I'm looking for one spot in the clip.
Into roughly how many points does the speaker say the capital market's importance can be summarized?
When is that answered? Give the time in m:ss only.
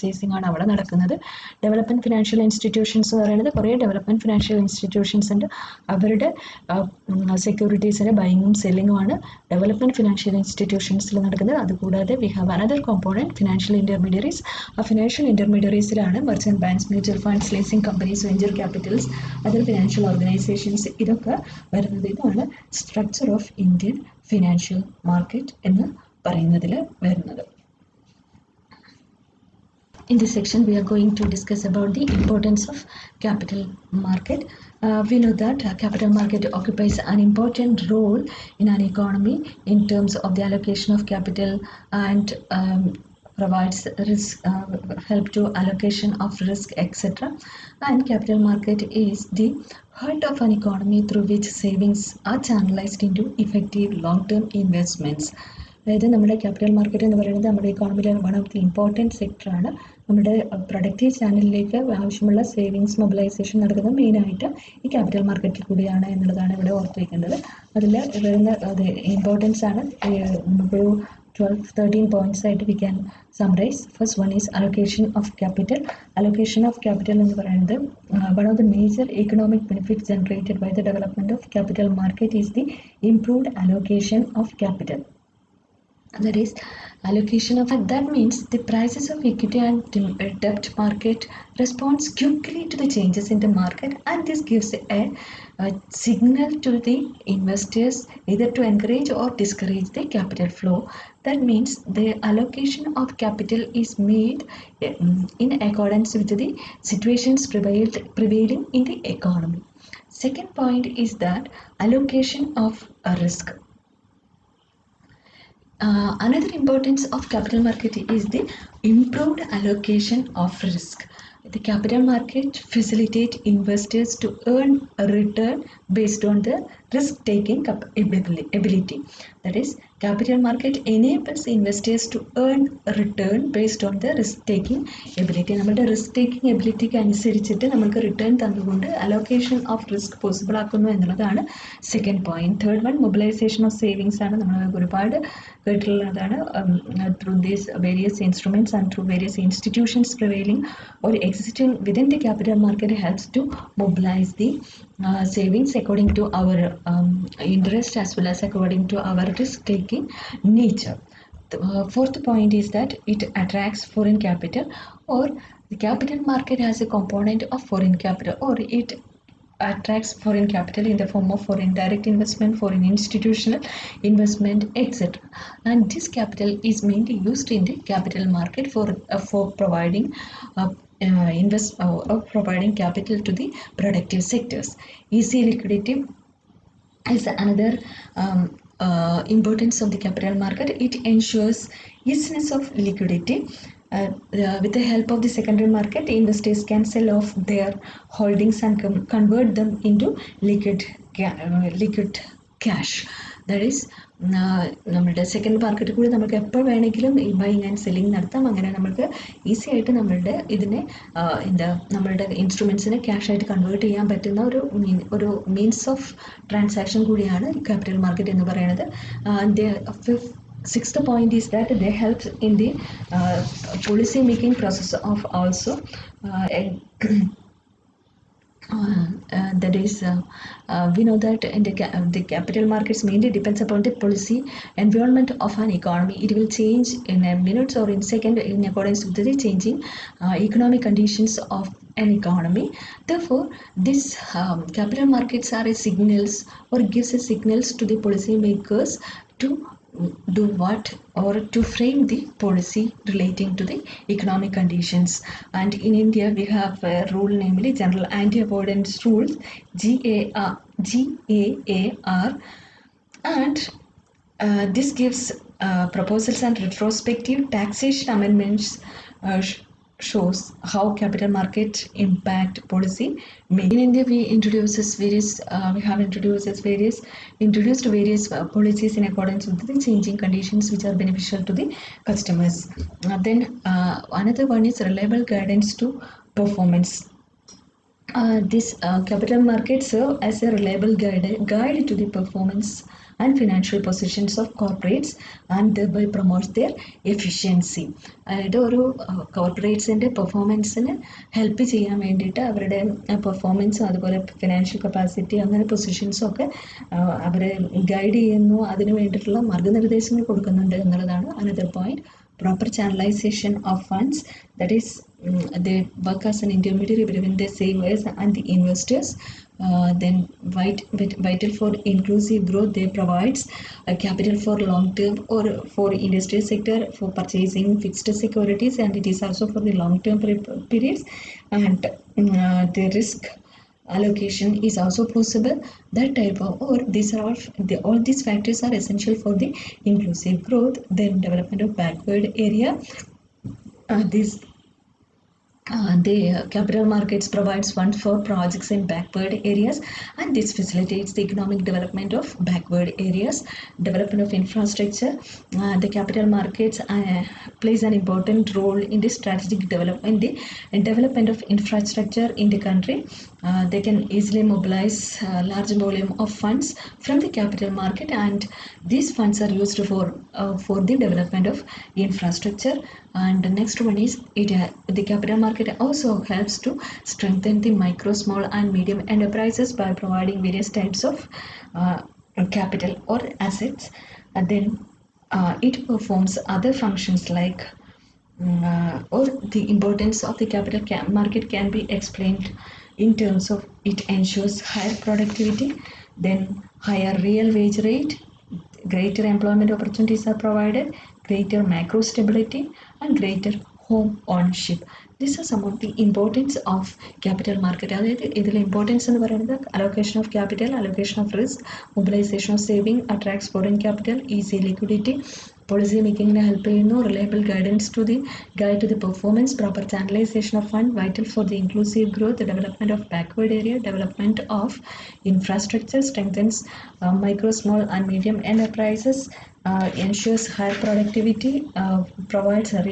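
1:11.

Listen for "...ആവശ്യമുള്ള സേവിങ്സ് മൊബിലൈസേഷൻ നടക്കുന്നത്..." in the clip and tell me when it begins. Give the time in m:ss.
1:01.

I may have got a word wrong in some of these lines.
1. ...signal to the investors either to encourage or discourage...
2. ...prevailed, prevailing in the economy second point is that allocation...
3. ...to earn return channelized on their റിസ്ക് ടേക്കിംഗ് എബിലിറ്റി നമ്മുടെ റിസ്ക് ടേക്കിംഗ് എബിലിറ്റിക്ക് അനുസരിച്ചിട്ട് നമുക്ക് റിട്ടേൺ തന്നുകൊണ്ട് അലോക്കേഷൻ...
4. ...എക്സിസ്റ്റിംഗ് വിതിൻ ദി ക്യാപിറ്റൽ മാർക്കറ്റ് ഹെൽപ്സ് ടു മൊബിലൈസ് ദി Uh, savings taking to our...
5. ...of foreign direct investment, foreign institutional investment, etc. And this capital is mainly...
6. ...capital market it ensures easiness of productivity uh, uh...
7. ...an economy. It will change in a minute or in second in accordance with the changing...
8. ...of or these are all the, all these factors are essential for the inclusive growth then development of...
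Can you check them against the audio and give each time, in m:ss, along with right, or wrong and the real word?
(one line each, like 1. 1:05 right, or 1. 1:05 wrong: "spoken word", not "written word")
1. 1:35 right
2. 1:47 right
3. 2:12 wrong: "based", not "channelized"
4. 2:31 wrong: "according", not "taking"
5. 2:51 right
6. 3:09 wrong: "liquidity", not "productivity"
7. 3:55 right
8. 5:36 right.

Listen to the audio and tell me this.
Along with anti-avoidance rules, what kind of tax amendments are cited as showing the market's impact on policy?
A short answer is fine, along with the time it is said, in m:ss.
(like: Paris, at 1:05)
Retrospective taxation, at 4:26.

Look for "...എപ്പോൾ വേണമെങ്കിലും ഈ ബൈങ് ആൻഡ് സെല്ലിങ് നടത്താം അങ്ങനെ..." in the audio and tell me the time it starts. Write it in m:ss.
3:26.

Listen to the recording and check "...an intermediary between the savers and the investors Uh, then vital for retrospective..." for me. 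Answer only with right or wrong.
wrong.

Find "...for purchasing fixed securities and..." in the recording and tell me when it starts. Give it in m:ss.
5:26.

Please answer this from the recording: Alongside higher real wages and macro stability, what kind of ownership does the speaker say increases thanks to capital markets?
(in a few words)
Home ownership.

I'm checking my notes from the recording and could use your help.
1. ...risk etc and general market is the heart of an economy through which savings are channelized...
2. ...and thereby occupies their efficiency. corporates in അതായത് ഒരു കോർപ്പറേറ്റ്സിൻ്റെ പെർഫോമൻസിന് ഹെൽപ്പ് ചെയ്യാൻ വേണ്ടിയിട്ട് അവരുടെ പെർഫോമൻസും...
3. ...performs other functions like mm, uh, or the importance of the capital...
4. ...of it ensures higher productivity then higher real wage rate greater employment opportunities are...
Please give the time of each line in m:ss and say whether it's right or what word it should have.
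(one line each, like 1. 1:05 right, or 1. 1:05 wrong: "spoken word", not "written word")
1. 0:46 wrong: "capital", not "general"
2. 4:55 wrong: "promotes", not "occupies"
3. 6:25 right
4. 6:33 right.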